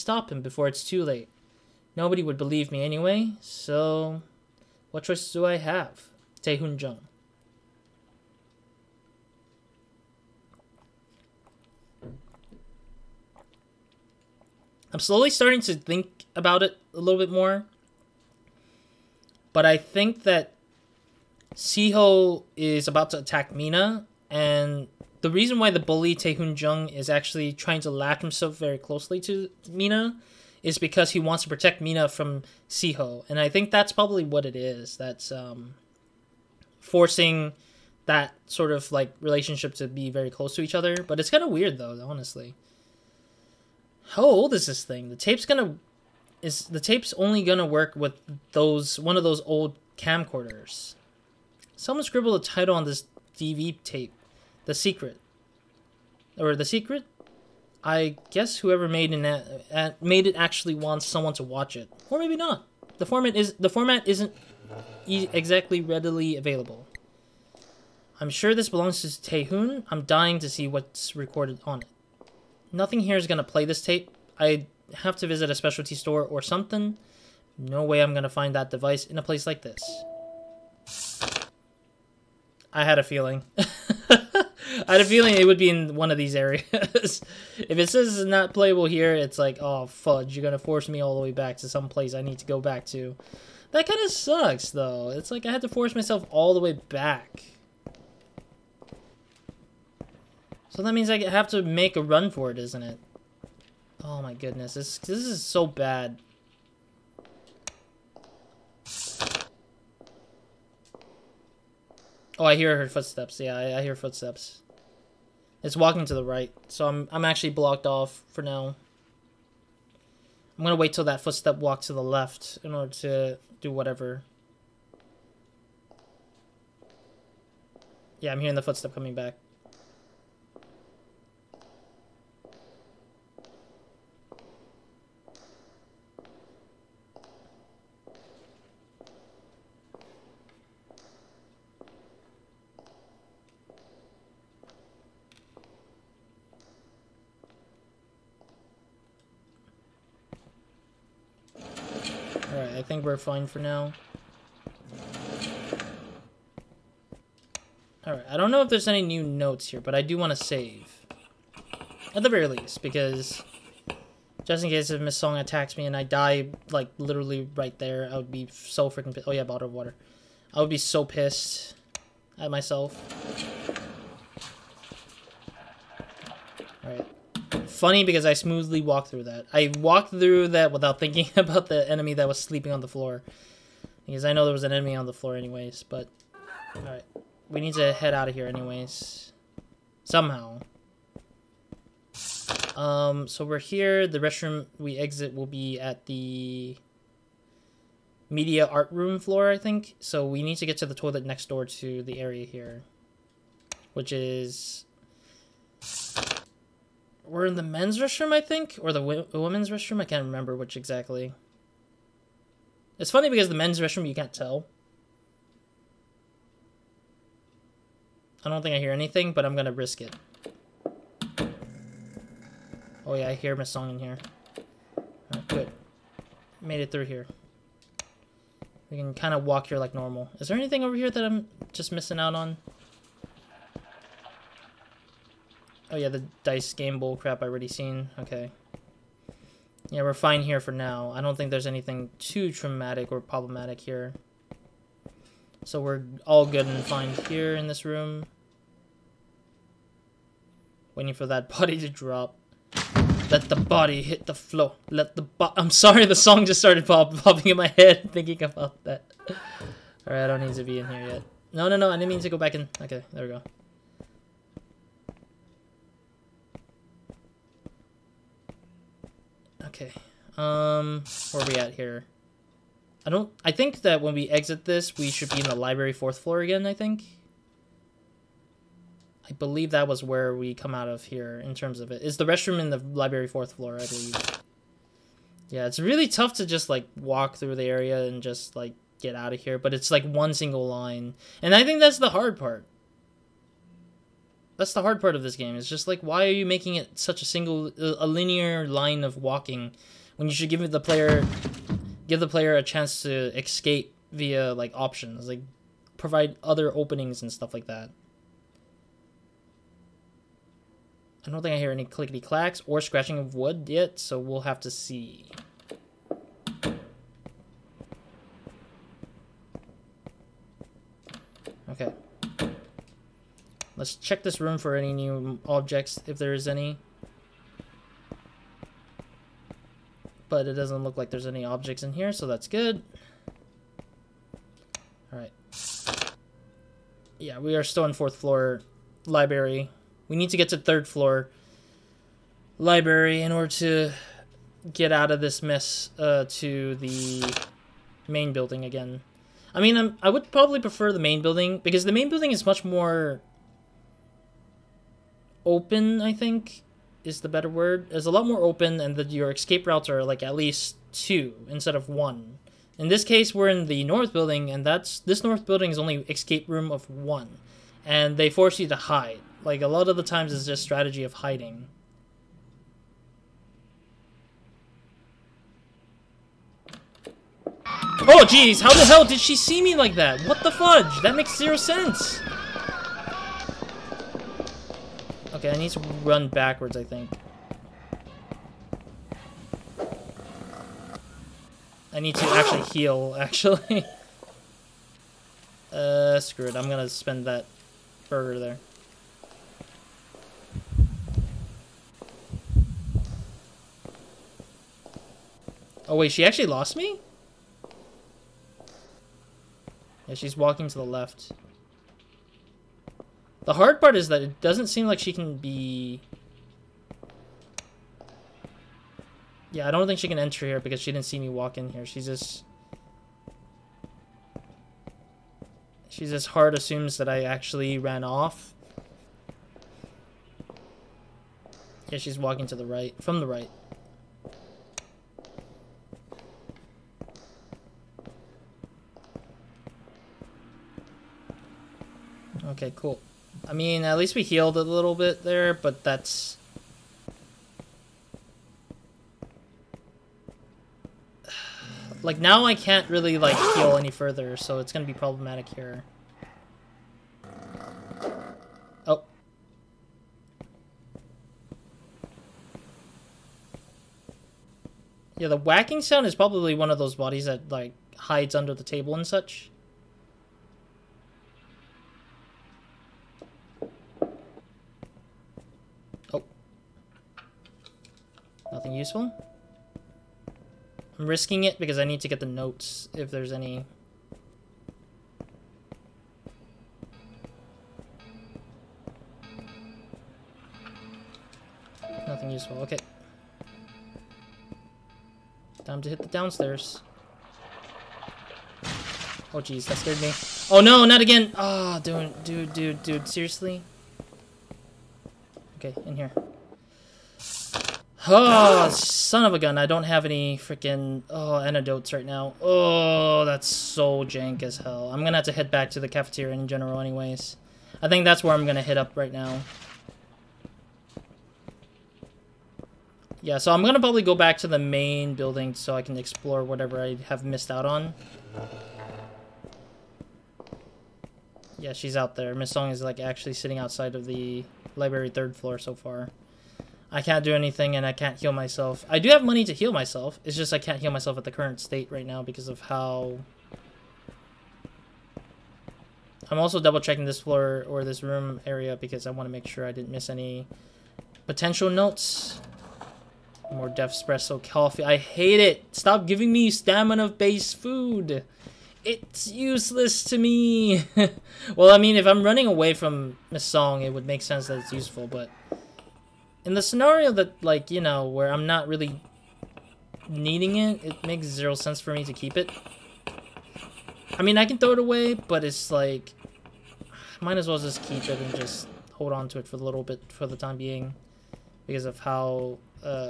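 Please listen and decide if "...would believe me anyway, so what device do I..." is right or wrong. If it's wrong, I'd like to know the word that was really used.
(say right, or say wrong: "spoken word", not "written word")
wrong: "choice", not "device".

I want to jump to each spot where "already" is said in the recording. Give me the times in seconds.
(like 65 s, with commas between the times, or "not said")
237 s.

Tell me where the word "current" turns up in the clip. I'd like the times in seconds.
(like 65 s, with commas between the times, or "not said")
541 s.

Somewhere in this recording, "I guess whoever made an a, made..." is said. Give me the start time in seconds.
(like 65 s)
57 s.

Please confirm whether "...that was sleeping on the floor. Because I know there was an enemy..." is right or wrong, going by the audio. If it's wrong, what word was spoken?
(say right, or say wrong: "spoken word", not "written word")
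right.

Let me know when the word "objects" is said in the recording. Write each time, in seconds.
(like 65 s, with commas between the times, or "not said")
325 s, 331 s.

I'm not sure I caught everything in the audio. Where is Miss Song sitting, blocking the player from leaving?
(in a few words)
Library third floor.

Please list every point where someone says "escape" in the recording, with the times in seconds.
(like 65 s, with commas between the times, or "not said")
303 s, 359 s, 366 s.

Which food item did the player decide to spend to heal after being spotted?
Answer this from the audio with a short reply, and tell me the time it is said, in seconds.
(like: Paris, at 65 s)
Burger, at 398 s.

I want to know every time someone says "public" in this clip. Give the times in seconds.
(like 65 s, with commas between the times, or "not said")
not said.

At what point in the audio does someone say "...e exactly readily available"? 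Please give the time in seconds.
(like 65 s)
65 s.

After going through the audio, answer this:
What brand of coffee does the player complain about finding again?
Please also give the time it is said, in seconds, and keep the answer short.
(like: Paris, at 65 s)
Def Espresso, at 553 s.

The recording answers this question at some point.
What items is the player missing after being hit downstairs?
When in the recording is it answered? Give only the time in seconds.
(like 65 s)
511 s.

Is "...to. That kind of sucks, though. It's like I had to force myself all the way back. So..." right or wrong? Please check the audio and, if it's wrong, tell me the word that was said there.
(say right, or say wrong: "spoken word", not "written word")
right.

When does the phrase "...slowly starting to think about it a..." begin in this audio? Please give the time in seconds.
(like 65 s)
14 s.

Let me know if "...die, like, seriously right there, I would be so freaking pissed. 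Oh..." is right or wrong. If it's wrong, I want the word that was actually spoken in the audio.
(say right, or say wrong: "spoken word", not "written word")
wrong: "literally", not "seriously".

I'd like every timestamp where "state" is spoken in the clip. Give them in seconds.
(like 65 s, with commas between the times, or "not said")
541 s.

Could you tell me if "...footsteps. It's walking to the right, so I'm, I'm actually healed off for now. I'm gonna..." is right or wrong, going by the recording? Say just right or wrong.
wrong.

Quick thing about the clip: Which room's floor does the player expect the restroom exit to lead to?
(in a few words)
Media art room.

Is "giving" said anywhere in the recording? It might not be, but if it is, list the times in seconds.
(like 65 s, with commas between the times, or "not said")
556 s.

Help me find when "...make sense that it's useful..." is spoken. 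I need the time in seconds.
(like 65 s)
564 s.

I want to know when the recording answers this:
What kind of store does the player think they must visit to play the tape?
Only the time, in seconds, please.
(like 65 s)
75 s.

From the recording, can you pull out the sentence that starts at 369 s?
Like a lot of the times, it's just strategy of hiding.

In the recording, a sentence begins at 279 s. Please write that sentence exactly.
I believe that was where we come out of here in terms of it.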